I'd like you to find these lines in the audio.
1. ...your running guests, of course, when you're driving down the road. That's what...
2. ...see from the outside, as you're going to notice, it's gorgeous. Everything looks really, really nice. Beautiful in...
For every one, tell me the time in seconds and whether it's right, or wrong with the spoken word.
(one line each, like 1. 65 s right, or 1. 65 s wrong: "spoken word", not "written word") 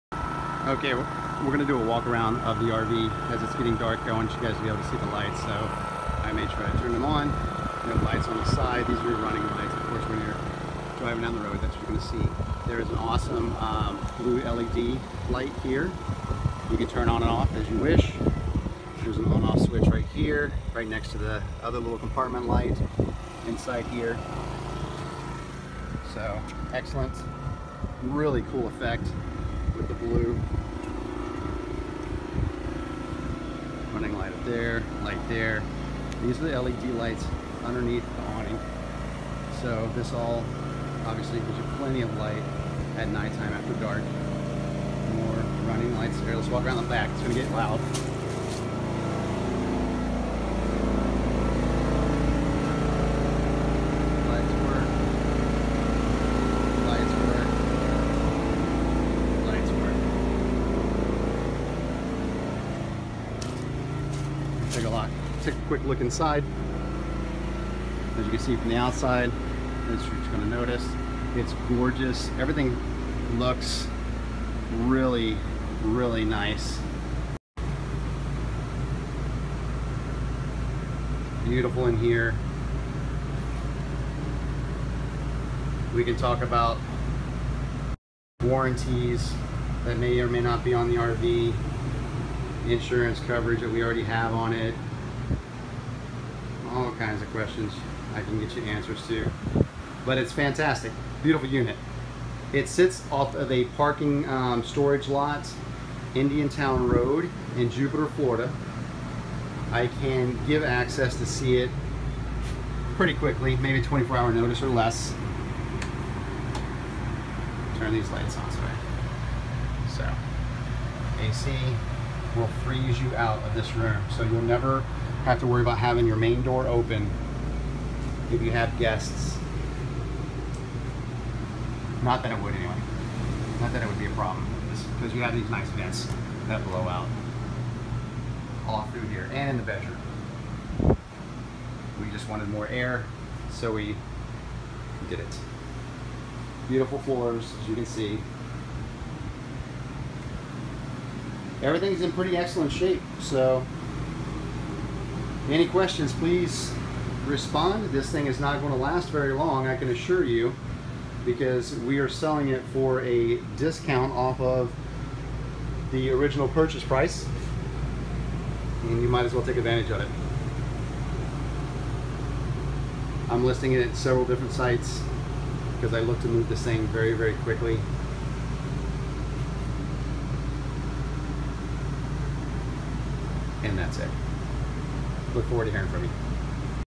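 1. 9 s wrong: "lights", not "guests"
2. 68 s right.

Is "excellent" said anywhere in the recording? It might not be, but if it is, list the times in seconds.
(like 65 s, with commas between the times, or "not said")
26 s, 152 s.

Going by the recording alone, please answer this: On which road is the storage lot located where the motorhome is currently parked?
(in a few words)
Indiantown Road.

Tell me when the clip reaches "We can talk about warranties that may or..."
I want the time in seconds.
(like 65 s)
85 s.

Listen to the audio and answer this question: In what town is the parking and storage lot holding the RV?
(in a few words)
Jupiter, Florida.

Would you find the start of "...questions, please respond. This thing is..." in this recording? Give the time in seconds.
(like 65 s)
155 s.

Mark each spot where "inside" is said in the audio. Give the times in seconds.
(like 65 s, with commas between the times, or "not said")
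23 s, 66 s.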